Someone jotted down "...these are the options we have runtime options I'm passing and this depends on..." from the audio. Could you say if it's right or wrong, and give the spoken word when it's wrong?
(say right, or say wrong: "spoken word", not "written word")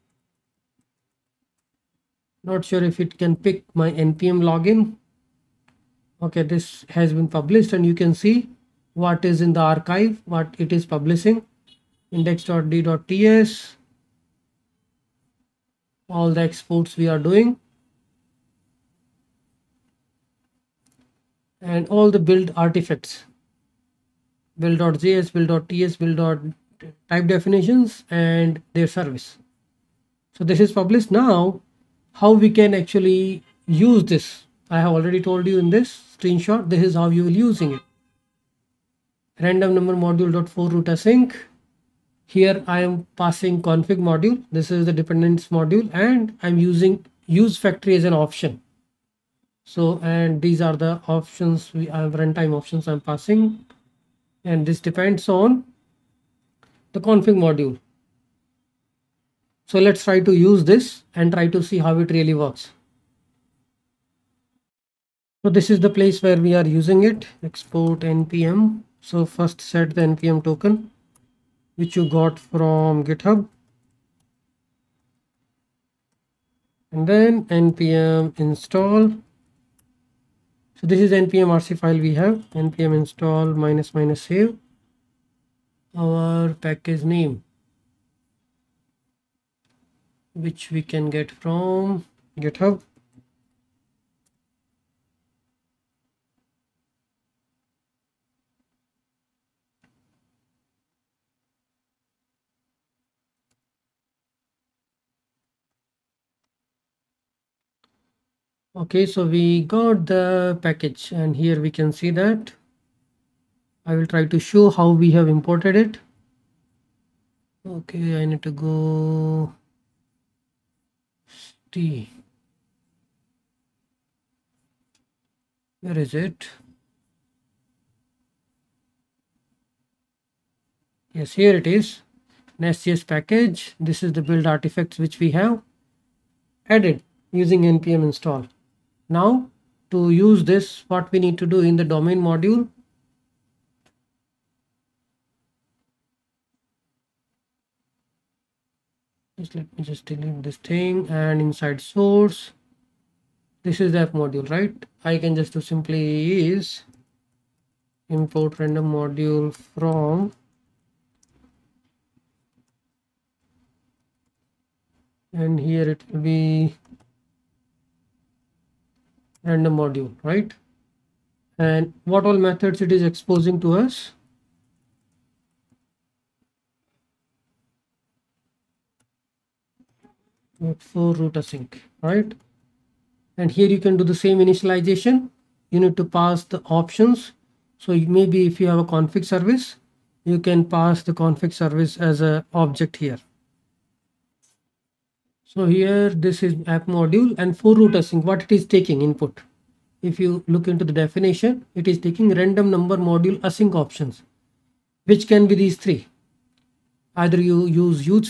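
right.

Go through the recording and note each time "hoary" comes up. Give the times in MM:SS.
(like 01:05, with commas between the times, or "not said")
not said.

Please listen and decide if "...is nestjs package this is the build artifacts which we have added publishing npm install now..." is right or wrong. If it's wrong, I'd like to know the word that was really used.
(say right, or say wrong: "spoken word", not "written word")
wrong: "using", not "publishing".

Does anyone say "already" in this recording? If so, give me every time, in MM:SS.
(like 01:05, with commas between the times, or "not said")
00:34.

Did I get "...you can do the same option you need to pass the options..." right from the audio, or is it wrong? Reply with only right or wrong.
wrong.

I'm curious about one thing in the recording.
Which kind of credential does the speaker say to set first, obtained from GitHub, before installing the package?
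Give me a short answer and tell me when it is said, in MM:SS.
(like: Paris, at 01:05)
npm token, at 01:10.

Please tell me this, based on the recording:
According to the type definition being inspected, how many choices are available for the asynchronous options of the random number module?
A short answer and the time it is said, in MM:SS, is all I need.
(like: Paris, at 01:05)
3, at 03:25.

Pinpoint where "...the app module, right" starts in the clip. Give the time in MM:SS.
02:33.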